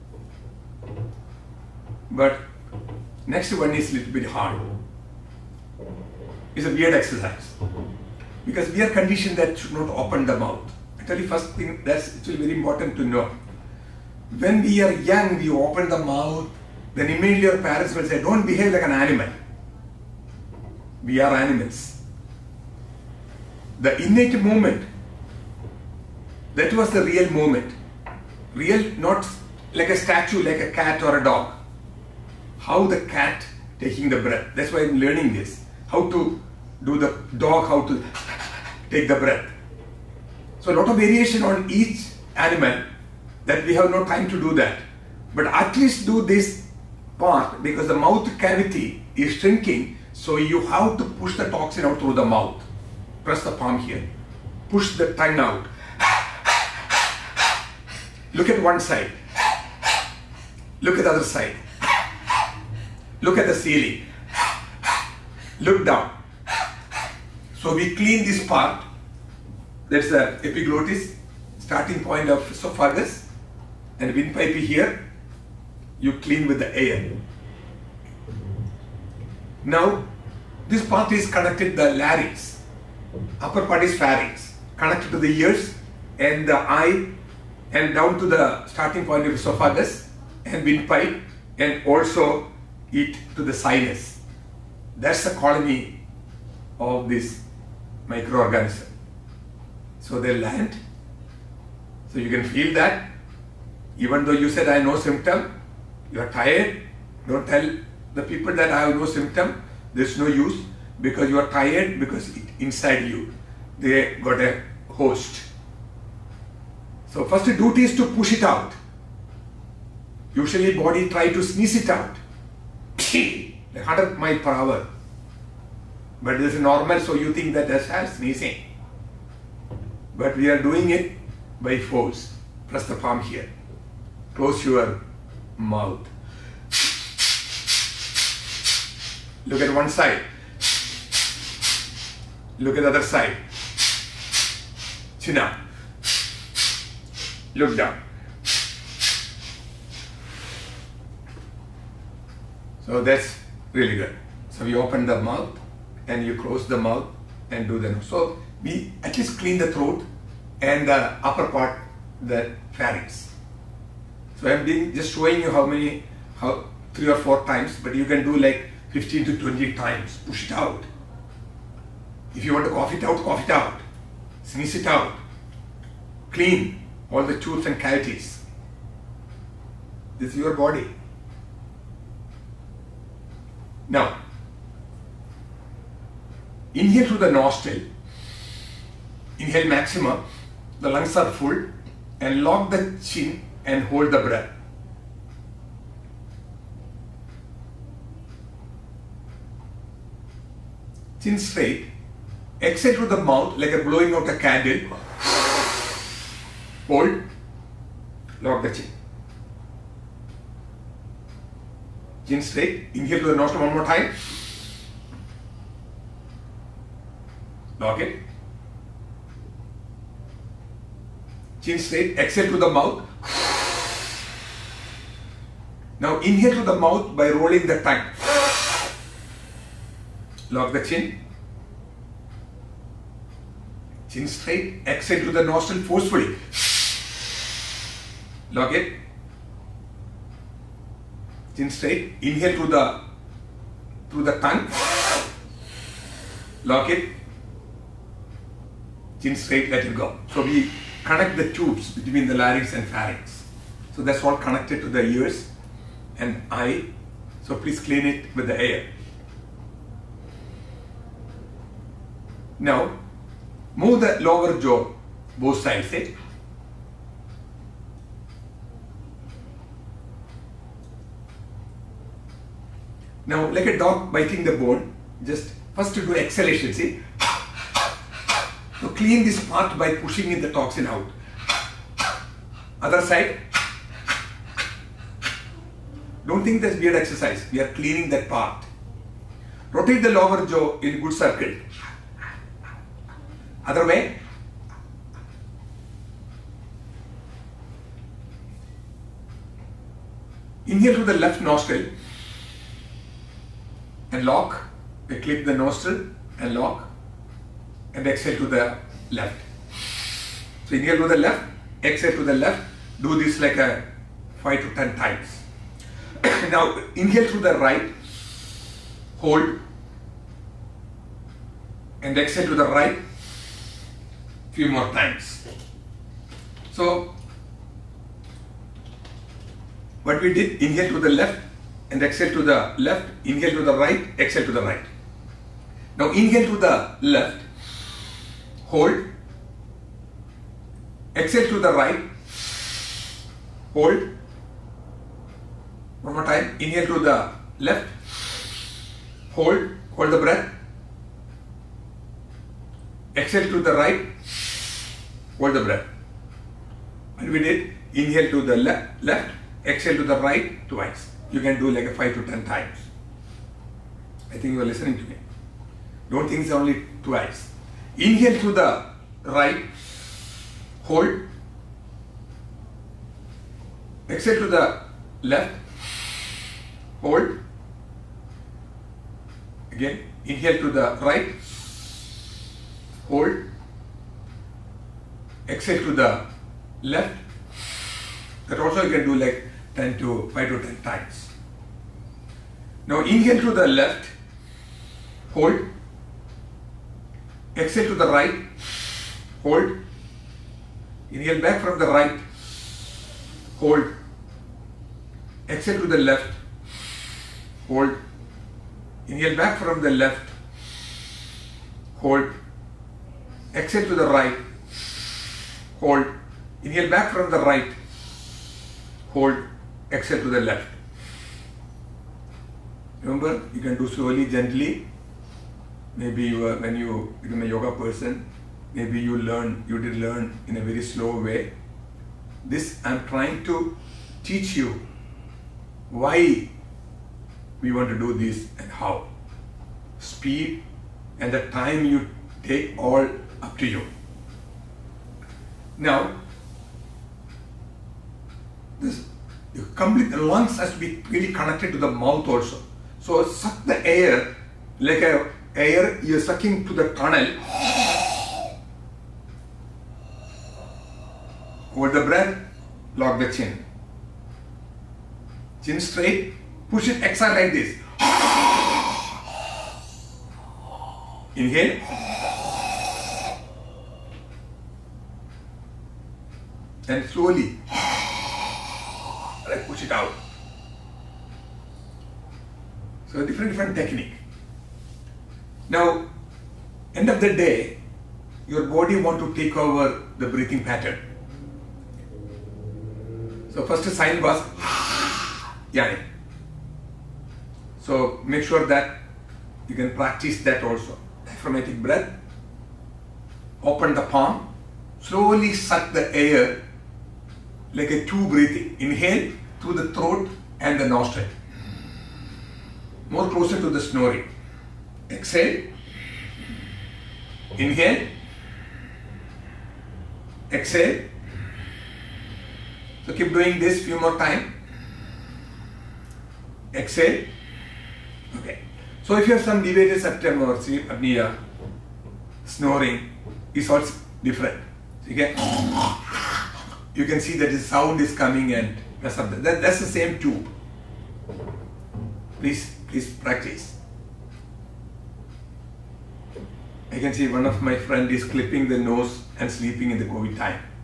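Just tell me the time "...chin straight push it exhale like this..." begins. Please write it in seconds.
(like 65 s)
465 s.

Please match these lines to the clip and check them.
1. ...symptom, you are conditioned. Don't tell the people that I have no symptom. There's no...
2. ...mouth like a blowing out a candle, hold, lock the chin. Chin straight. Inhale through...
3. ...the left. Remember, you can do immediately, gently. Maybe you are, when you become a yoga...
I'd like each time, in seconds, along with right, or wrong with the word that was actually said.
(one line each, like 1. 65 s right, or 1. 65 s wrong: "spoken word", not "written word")
1. 104 s wrong: "tired", not "conditioned"
2. 203 s right
3. 420 s wrong: "slowly", not "immediately".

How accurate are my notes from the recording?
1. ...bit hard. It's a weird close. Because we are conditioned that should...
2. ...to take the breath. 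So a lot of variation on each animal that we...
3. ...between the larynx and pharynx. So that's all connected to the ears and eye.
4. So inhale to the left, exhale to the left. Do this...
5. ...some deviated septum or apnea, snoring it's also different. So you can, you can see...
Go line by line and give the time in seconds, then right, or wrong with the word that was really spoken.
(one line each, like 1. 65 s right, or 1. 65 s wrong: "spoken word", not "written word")
1. 4 s wrong: "exercise", not "close"
2. 37 s right
3. 251 s right
4. 310 s right
5. 529 s right.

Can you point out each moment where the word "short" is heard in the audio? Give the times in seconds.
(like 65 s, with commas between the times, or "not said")
not said.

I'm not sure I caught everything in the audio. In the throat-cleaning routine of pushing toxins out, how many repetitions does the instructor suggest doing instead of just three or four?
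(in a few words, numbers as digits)
15 to 20.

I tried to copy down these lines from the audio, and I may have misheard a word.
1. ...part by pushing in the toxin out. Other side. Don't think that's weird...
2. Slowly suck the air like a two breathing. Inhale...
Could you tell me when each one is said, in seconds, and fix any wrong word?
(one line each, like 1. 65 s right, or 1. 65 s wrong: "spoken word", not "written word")
1. 279 s right
2. 504 s right.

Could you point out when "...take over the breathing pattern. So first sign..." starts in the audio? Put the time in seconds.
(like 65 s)
489 s.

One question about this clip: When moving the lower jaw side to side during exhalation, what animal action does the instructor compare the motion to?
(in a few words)
a dog biting the bone.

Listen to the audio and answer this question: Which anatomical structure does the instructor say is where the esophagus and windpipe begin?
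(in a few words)
epiglottis.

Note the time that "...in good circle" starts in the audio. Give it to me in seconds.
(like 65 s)
290 s.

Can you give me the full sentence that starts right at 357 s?
And we did inhale to the left, left, exhale to the right twice you can do like 5 to 10 times.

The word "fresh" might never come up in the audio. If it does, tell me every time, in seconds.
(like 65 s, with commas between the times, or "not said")
not said.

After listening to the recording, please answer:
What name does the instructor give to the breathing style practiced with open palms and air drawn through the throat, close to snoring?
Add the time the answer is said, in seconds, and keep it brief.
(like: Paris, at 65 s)
Diaphragmatic breath, at 501 s.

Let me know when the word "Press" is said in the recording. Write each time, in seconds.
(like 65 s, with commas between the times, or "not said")
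53 s, 132 s.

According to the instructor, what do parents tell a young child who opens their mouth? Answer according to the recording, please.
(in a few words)
Don't behave like an animal.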